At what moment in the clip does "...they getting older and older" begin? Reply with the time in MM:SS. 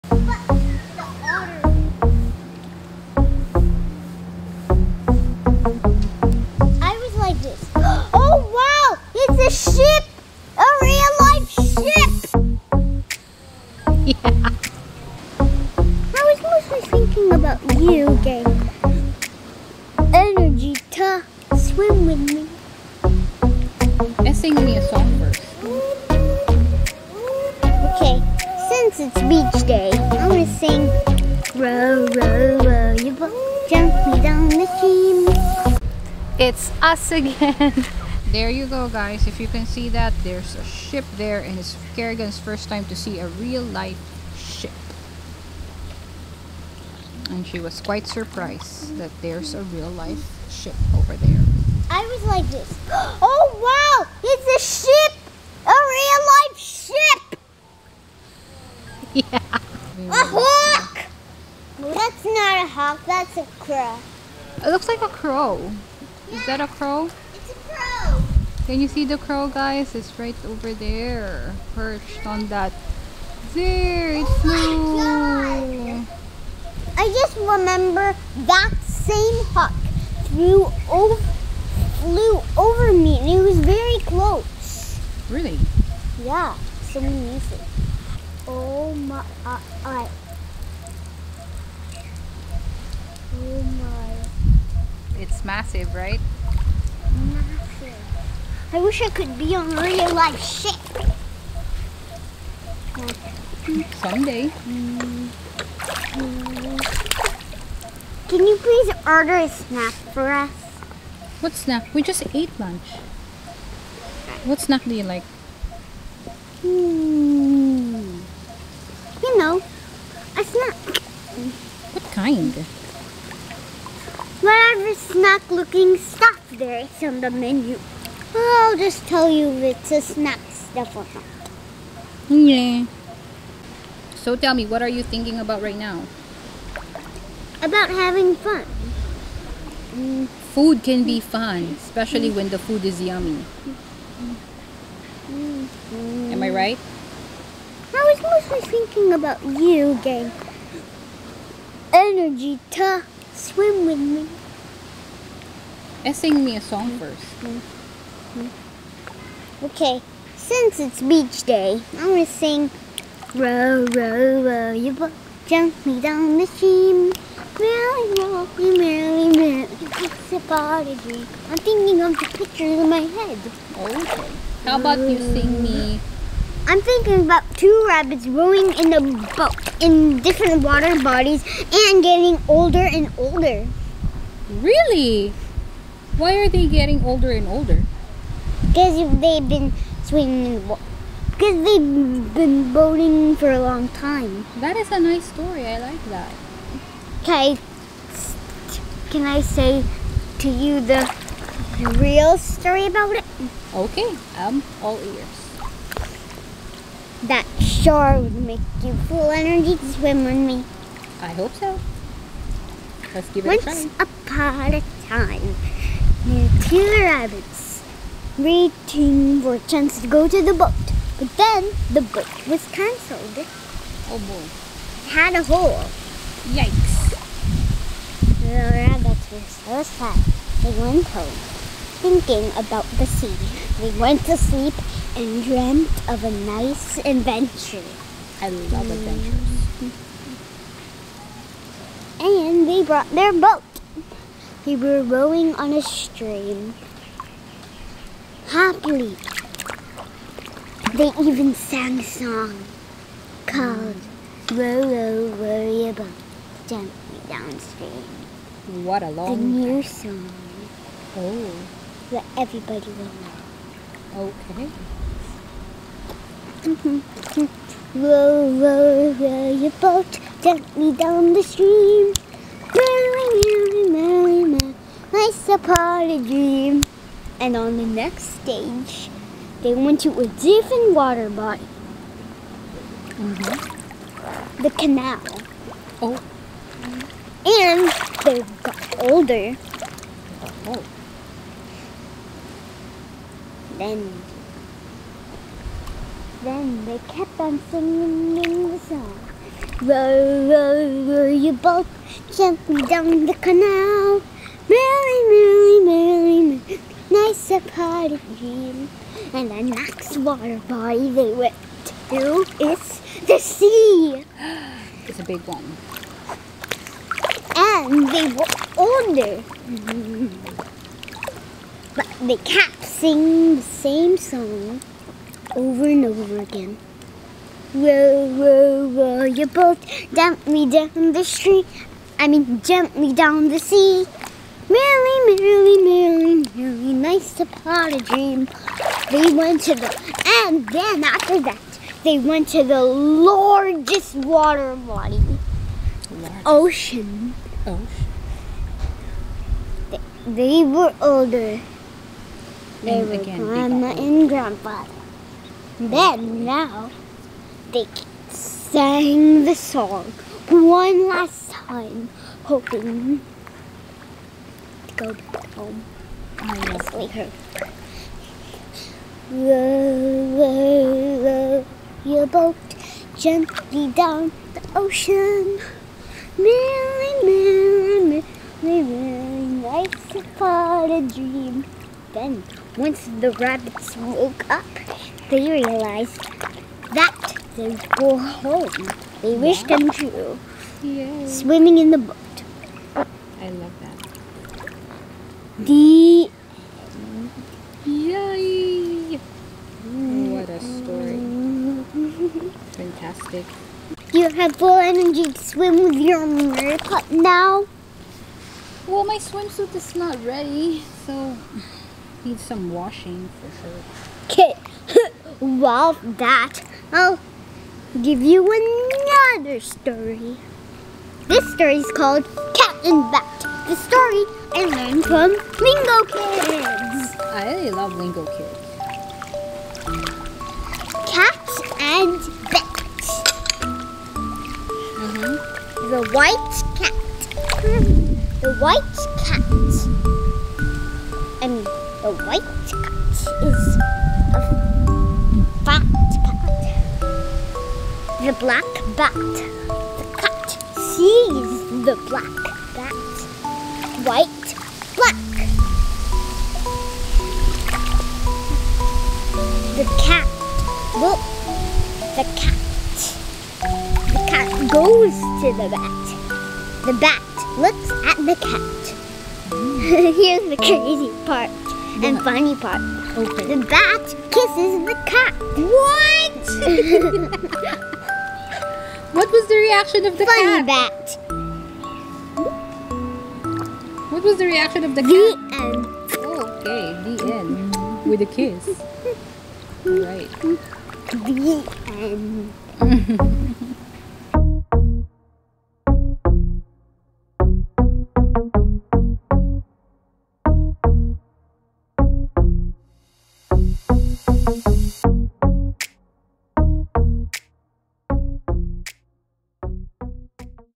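03:06.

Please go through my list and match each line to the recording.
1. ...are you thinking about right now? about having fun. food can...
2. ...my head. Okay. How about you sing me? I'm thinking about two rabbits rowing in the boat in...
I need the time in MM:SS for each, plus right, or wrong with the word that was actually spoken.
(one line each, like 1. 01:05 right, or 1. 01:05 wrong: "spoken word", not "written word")
1. 02:14 right
2. 02:52 right.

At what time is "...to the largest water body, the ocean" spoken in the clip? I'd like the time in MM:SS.
05:42.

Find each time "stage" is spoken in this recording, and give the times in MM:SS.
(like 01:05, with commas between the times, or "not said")
04:38.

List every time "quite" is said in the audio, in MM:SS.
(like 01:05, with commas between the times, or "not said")
00:47.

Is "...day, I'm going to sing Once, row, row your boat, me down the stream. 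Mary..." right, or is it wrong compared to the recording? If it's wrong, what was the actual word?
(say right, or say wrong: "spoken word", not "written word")
wrong: "Row", not "Once".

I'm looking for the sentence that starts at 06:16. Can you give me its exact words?
Really, really, really, nice about a dream.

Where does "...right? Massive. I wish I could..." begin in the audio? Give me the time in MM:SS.
01:35.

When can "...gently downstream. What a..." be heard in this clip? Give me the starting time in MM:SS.
04:16.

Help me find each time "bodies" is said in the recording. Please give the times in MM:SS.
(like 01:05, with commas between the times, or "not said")
03:01.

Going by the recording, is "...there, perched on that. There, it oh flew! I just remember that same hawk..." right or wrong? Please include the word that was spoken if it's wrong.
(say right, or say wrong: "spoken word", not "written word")
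right.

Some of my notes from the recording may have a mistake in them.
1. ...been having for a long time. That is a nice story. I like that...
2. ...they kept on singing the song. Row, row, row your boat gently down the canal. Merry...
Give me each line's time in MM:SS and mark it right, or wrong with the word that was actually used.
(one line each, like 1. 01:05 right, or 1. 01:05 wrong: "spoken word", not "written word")
1. 03:12 wrong: "boating", not "having"
2. 04:56 right.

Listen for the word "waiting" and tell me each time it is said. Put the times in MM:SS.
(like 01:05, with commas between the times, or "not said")
03:38.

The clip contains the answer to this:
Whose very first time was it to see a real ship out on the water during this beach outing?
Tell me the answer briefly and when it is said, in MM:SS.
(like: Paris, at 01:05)
Kerrigan, at 00:41.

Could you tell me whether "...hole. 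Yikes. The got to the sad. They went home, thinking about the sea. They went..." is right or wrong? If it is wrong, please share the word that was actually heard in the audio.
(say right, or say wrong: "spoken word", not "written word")
right.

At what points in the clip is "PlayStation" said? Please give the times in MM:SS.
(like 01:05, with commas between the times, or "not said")
not said.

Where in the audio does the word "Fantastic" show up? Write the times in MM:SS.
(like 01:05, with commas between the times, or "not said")
06:42.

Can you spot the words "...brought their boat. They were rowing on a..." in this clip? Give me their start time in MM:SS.
04:02.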